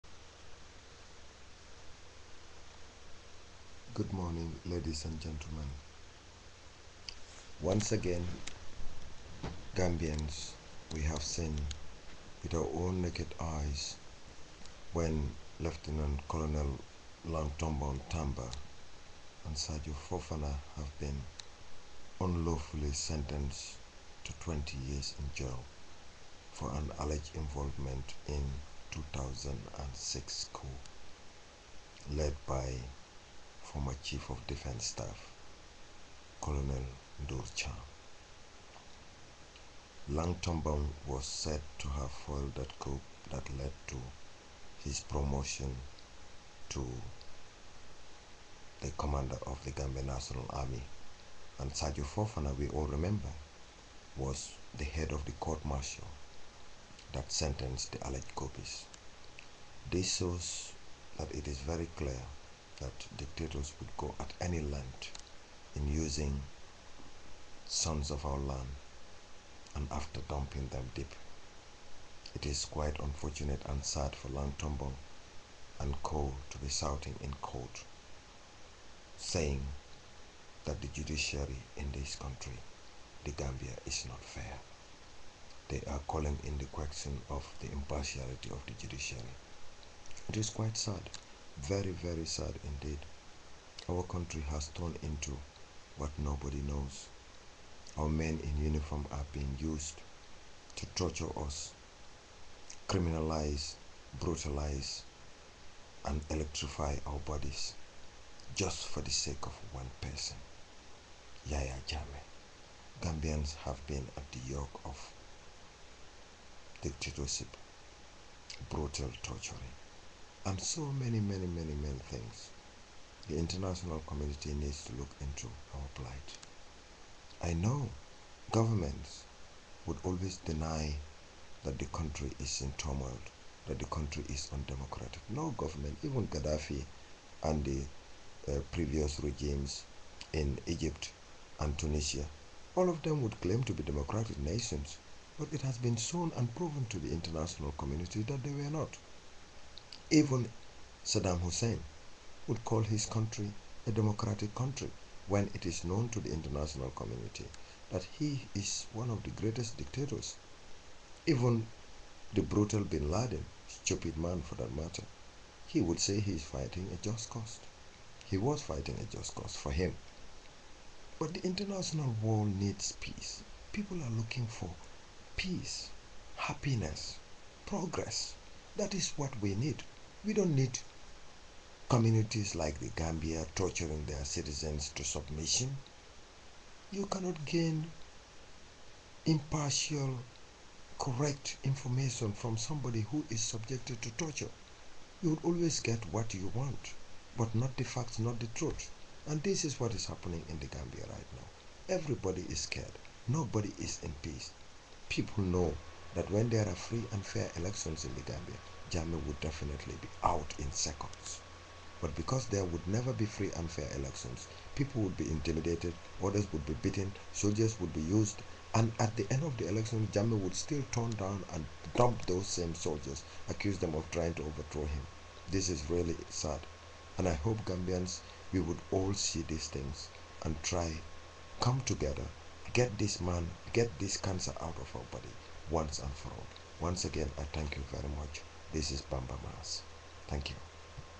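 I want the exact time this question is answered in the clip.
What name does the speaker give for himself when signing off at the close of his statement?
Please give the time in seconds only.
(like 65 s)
239 s.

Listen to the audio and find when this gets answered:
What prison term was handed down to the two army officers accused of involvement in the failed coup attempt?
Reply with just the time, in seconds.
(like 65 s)
24 s.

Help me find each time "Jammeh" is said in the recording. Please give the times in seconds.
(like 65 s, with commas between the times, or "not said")
111 s, 208 s, 220 s.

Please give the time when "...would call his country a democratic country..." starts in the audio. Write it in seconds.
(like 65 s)
152 s.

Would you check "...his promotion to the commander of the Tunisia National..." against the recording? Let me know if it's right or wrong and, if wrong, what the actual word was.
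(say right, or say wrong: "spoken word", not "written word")
wrong: "Gambia", not "Tunisia".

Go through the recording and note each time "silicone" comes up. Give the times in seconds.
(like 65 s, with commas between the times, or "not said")
not said.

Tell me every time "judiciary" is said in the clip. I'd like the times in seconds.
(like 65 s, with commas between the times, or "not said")
80 s, 88 s.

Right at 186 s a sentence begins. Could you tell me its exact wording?
You cannot gain impartial, correct information from somebody who is subjected to torture.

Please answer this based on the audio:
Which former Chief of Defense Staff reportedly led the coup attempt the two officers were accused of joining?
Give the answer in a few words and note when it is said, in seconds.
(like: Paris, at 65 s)
Colonel Ndurcha, at 36 s.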